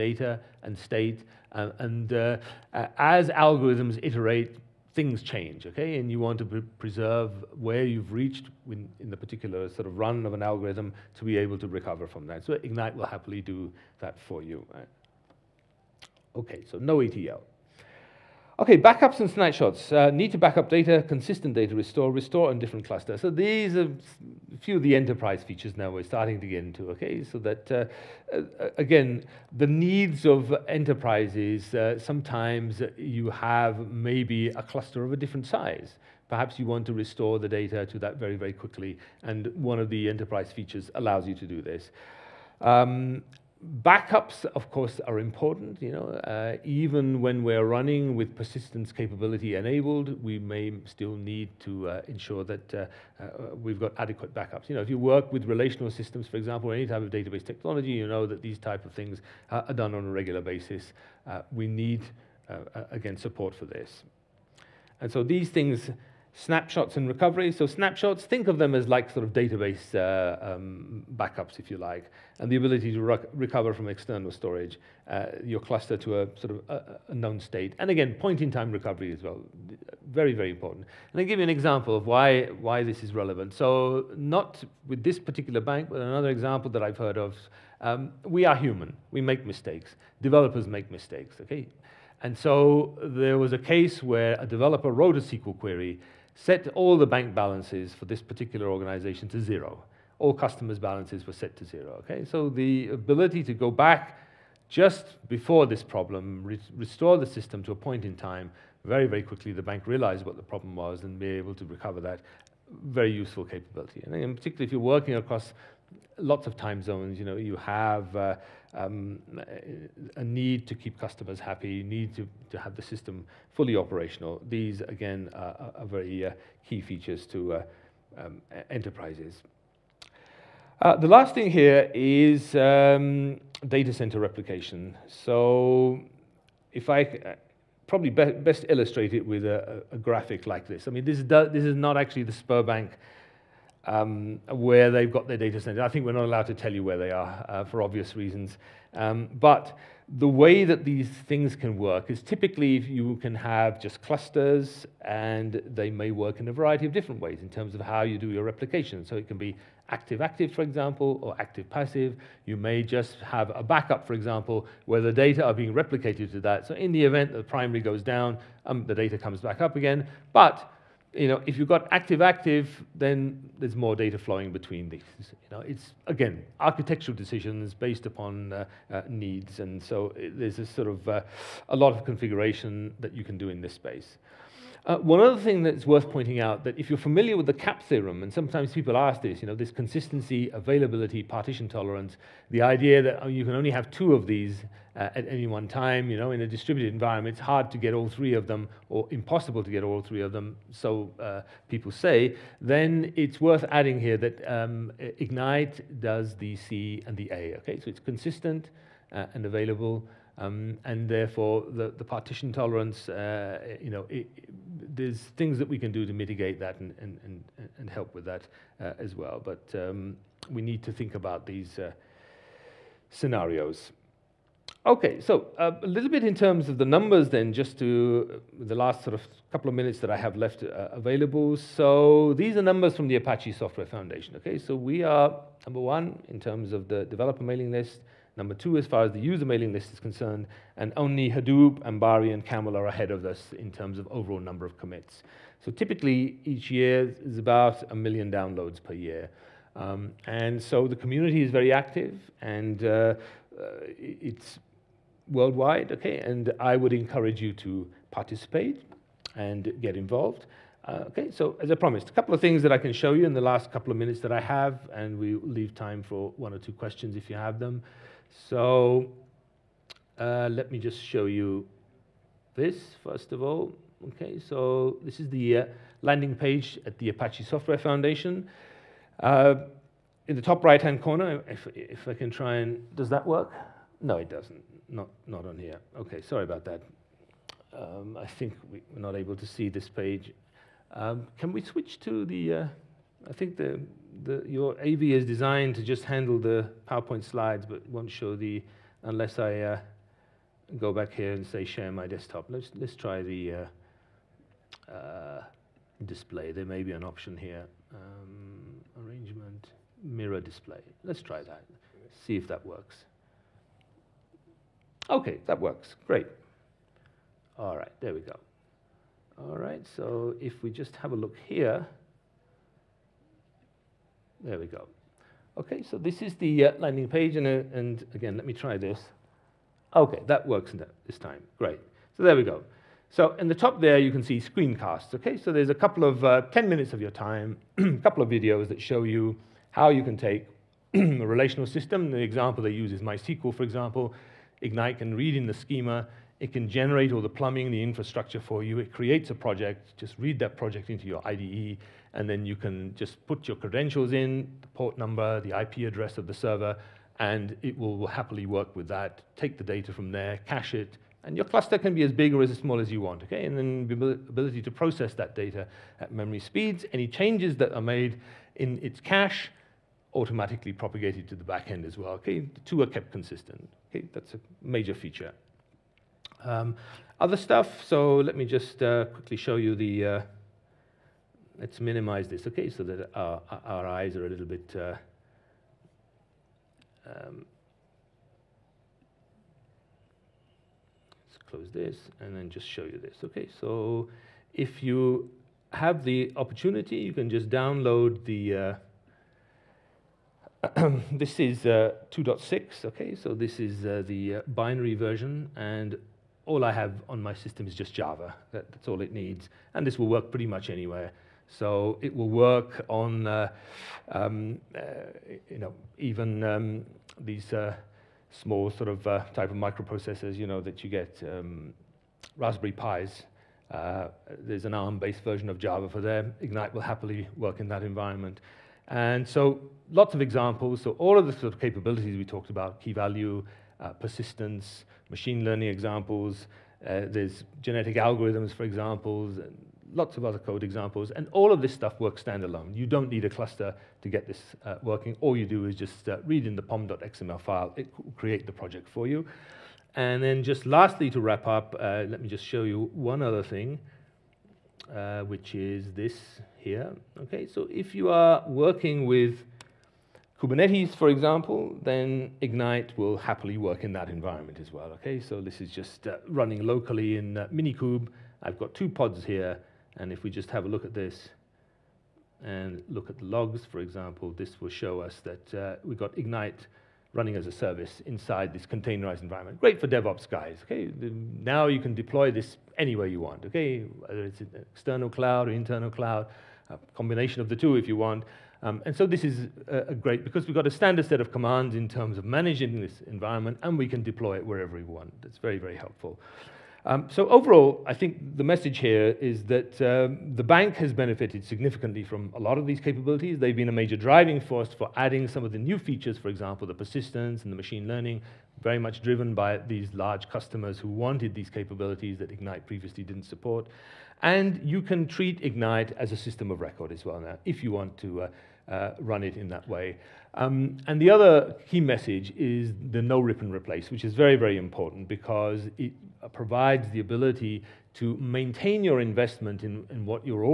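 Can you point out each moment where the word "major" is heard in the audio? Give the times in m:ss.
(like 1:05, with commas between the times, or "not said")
6:14, 8:23.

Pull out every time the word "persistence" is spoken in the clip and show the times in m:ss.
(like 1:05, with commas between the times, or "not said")
0:48, 7:13, 8:26.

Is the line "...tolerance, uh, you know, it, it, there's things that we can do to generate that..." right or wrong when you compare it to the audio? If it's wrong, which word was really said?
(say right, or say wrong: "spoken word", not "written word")
wrong: "mitigate", not "generate".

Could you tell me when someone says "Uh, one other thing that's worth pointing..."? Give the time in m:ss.
3:04.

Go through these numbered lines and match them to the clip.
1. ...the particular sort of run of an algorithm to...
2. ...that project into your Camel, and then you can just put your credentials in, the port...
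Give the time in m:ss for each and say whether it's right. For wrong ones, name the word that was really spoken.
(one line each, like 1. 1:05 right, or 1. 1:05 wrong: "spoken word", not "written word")
1. 0:09 right
2. 5:50 wrong: "IDE", not "Camel".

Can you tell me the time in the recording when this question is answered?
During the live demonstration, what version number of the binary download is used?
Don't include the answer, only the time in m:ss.
6:42.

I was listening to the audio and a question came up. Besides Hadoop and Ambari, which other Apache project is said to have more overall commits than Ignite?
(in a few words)
Camel.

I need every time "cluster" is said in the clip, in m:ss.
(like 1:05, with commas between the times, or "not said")
0:22, 0:34, 1:15, 2:34, 6:01, 7:23.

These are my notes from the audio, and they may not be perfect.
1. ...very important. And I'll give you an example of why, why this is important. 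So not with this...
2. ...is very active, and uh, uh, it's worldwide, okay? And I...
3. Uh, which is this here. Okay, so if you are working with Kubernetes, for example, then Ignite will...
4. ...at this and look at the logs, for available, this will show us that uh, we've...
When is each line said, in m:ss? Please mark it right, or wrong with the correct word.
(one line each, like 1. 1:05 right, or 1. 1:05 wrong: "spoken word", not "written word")
1. 1:20 wrong: "relevant", not "important"
2. 4:11 right
3. 7:34 right
4. 7:50 wrong: "example", not "available".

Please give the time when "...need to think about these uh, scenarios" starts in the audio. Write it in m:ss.
3:40.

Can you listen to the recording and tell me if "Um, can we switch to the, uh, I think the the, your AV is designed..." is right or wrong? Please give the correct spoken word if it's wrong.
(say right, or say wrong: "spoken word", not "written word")
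right.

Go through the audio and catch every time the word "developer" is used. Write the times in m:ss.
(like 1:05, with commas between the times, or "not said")
1:30, 1:34, 3:57.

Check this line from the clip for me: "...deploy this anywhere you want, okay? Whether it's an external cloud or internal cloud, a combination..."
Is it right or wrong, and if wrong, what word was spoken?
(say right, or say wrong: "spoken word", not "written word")
right.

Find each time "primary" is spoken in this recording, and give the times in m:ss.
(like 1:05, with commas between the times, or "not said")
2:47.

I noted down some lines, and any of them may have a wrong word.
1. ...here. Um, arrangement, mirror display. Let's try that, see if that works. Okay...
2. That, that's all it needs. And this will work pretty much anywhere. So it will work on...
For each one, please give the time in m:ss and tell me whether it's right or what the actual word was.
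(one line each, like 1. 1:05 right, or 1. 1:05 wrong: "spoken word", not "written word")
1. 5:07 right
2. 6:48 right.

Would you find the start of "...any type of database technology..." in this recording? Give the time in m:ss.
0:56.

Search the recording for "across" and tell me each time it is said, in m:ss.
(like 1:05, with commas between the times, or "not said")
1:55.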